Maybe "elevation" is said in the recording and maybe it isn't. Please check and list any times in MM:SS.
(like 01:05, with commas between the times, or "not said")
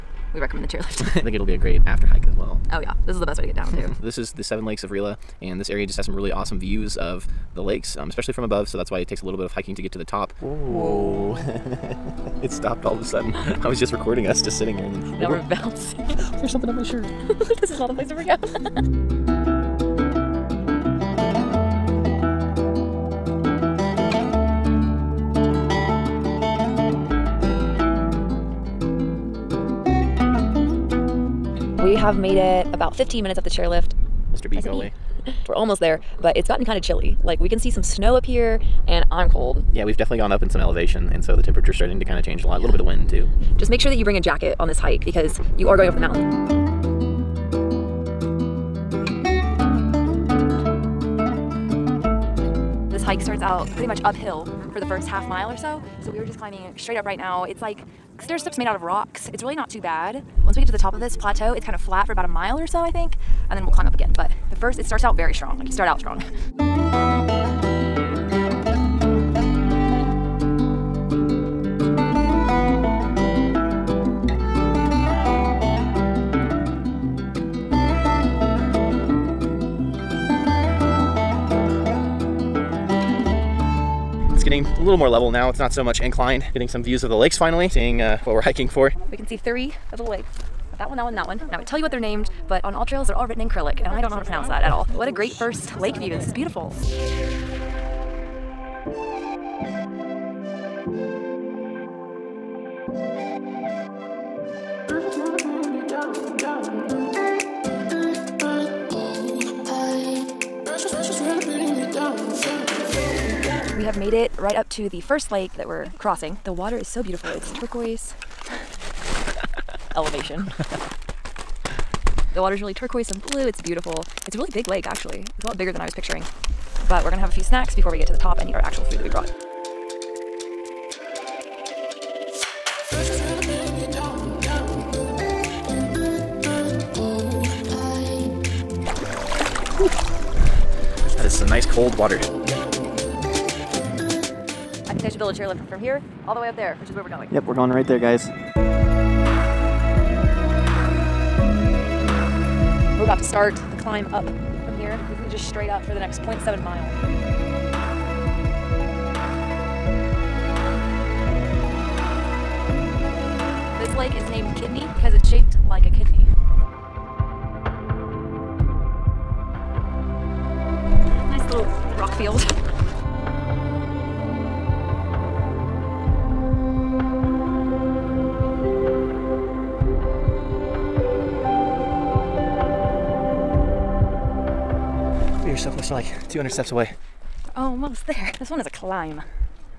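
00:40, 01:59.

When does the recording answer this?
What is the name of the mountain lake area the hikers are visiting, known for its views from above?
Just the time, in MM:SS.
00:04.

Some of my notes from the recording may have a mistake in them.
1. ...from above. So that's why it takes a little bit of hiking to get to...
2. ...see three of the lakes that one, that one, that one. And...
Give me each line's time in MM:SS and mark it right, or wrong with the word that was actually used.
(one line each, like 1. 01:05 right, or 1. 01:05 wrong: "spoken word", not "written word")
1. 00:08 right
2. 01:29 right.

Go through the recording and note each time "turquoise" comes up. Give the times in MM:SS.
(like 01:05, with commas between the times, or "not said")
01:57, 02:02.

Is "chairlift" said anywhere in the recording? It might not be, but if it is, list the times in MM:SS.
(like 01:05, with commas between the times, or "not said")
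00:00, 00:33, 02:25.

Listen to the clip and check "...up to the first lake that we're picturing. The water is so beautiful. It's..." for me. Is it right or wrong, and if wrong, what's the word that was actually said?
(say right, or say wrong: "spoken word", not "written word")
wrong: "crossing", not "picturing".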